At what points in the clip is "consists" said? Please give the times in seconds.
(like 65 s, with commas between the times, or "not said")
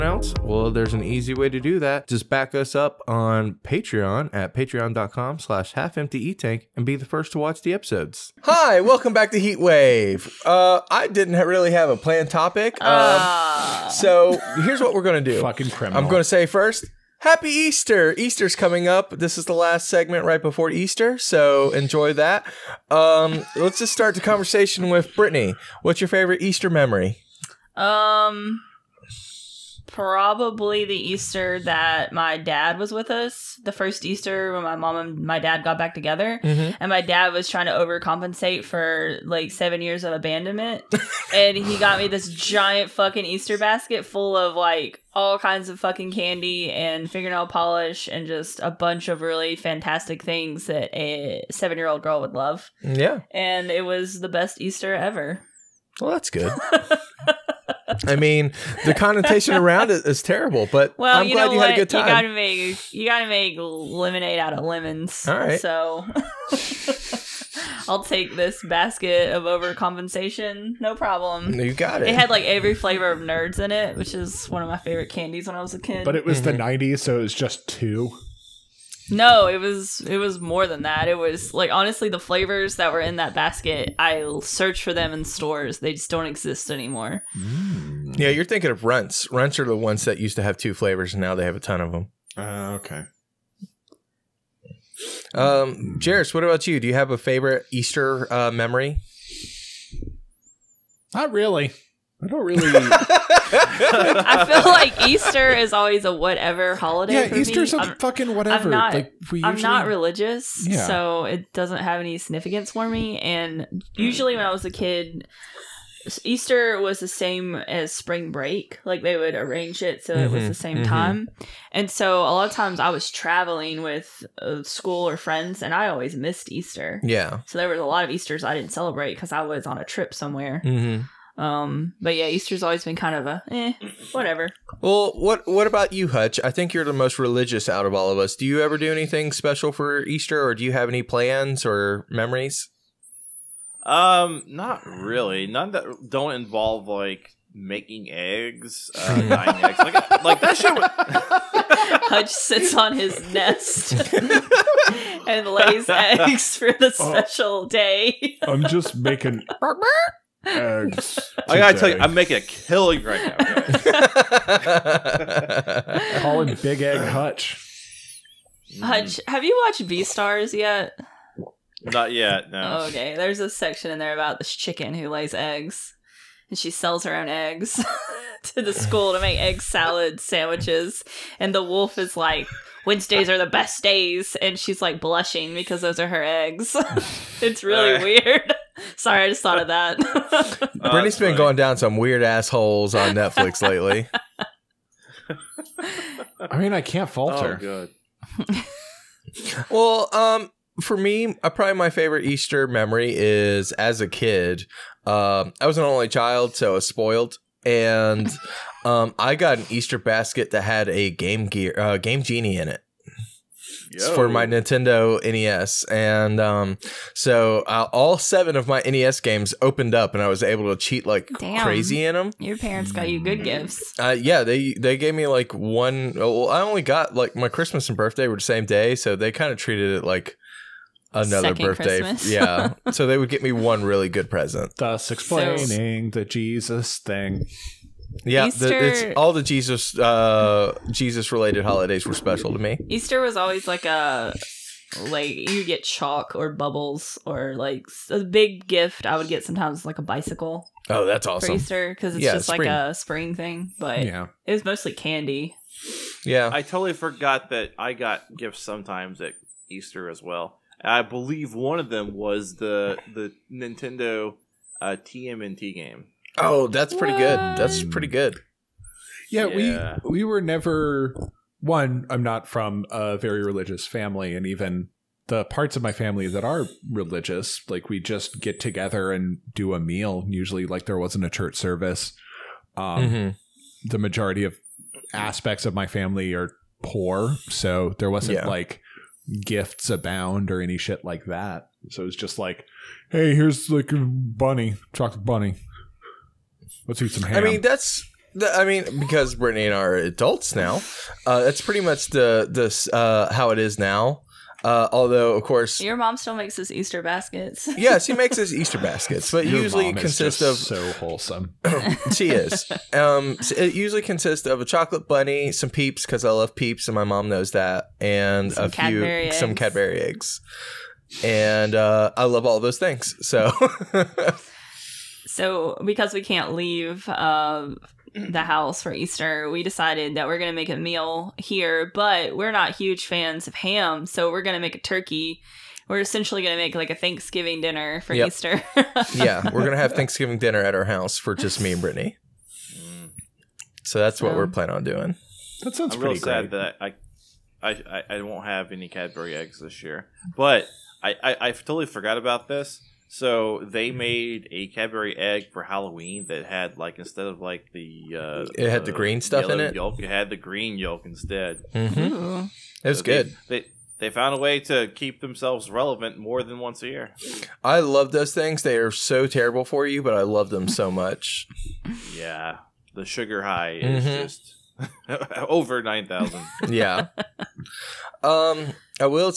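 309 s, 314 s.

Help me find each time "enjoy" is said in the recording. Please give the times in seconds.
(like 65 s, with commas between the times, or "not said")
21 s.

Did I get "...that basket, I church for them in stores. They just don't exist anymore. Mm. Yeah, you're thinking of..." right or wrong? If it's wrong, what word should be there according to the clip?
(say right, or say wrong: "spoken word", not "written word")
wrong: "search", not "church".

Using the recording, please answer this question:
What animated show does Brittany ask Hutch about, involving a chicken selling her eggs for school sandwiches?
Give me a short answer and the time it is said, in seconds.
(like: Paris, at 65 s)
Beastars, at 169 s.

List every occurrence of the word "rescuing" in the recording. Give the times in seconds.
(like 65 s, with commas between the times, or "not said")
not said.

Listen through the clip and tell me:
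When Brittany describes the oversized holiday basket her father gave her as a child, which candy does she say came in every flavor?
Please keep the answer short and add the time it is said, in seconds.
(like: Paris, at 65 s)
Nerds, at 73 s.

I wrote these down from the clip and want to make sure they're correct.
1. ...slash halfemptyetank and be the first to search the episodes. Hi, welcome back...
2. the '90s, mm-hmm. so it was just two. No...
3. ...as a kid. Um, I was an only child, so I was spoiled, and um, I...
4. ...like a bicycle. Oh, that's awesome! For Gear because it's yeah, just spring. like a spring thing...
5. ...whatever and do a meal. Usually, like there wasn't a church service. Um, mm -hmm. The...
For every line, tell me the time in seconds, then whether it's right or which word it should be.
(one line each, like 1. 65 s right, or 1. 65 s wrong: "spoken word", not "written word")
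1. 5 s wrong: "watch", not "search"
2. 76 s right
3. 203 s right
4. 249 s wrong: "Easter", not "Gear"
5. 278 s wrong: "together", not "whatever".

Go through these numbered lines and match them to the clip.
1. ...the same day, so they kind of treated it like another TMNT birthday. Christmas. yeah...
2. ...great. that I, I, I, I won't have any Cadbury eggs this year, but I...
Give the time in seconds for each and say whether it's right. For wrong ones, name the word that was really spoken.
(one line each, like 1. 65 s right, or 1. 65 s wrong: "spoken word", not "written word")
1. 228 s wrong: "Second", not "TMNT"
2. 346 s right.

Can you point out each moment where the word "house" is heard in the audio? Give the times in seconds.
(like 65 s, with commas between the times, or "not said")
328 s, 340 s.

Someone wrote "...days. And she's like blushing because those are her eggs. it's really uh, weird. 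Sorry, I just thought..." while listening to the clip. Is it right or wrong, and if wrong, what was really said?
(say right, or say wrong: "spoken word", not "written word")
right.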